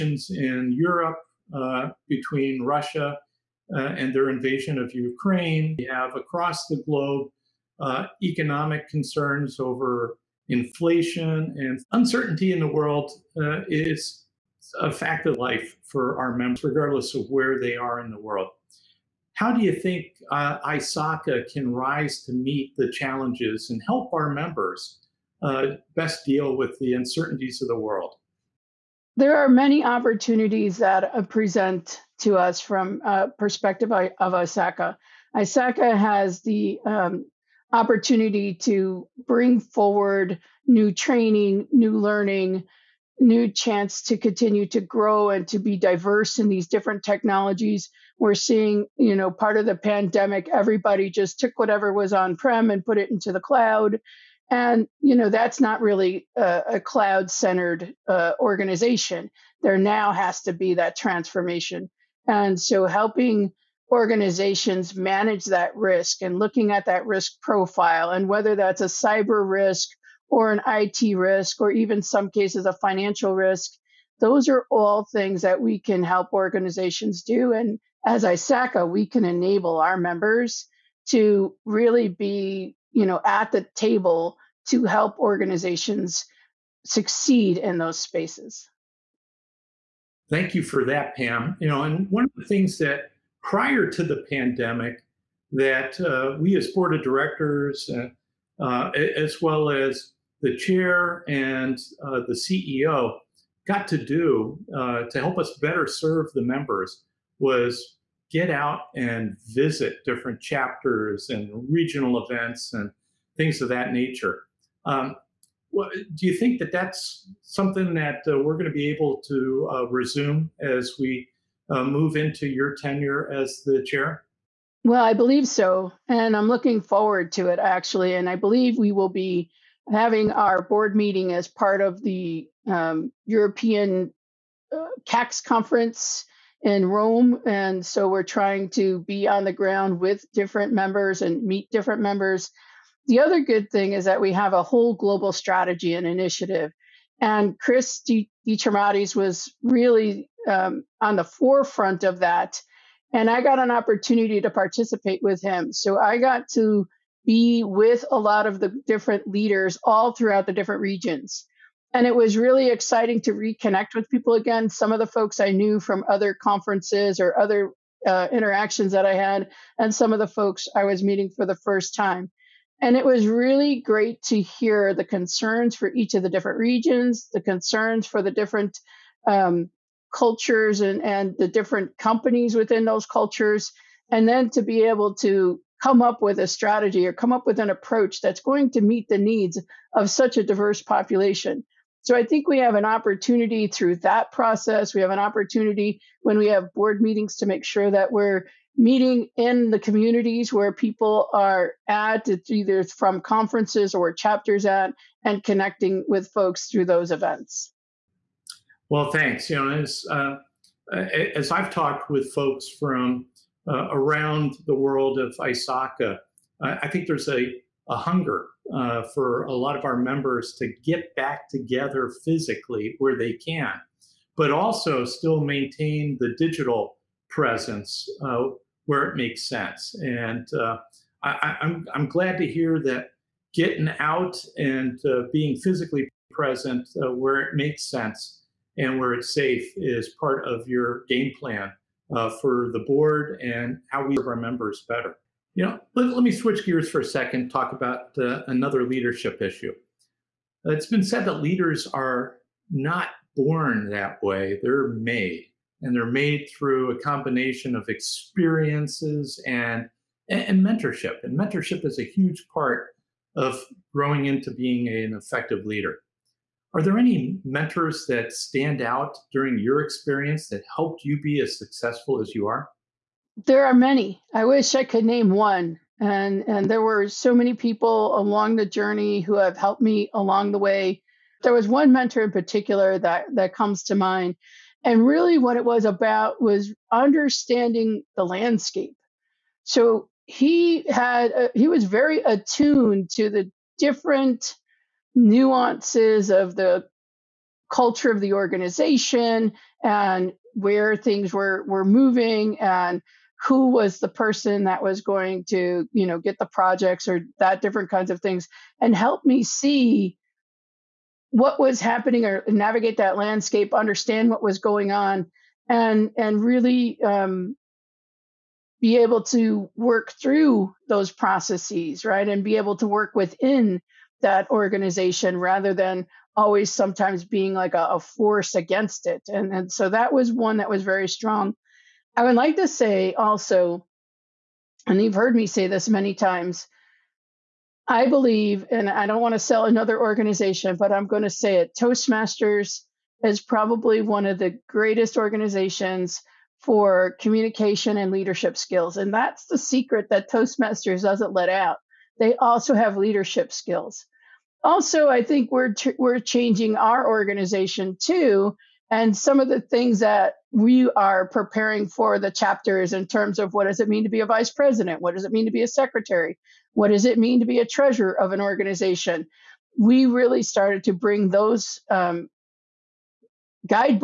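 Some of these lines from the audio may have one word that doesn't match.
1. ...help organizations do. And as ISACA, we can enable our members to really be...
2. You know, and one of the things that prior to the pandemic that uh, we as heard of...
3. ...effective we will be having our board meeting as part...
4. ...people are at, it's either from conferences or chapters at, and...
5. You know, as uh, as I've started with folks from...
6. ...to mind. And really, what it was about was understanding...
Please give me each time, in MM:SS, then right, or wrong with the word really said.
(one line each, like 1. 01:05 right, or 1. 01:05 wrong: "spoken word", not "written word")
1. 01:16 right
2. 01:31 wrong: "board", not "heard"
3. 02:08 wrong: "believe", not "effective"
4. 03:20 right
5. 03:29 wrong: "talked", not "started"
6. 04:43 right.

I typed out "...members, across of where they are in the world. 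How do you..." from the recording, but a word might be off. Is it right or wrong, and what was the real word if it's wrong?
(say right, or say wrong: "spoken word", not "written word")
wrong: "regardless", not "across".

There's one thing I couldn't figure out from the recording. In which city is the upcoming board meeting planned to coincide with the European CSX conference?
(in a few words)
Rome.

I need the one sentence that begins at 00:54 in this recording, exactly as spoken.
And, you know, that's not really a, a cloud centered uh, organization.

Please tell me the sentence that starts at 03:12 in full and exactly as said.
So I think we have an opportunity through that process.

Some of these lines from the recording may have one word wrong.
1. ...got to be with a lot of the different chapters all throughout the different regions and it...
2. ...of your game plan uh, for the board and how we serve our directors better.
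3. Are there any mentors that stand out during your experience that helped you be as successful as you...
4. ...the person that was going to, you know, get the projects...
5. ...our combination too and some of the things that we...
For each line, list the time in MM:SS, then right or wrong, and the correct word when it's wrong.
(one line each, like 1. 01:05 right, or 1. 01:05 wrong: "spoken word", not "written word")
1. 02:36 wrong: "leaders", not "chapters"
2. 04:00 wrong: "members", not "directors"
3. 04:26 right
4. 05:03 right
5. 05:56 wrong: "organization", not "combination".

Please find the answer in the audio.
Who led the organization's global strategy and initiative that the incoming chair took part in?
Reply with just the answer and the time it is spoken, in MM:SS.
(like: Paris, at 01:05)
Chris Dimitriadis, at 02:27.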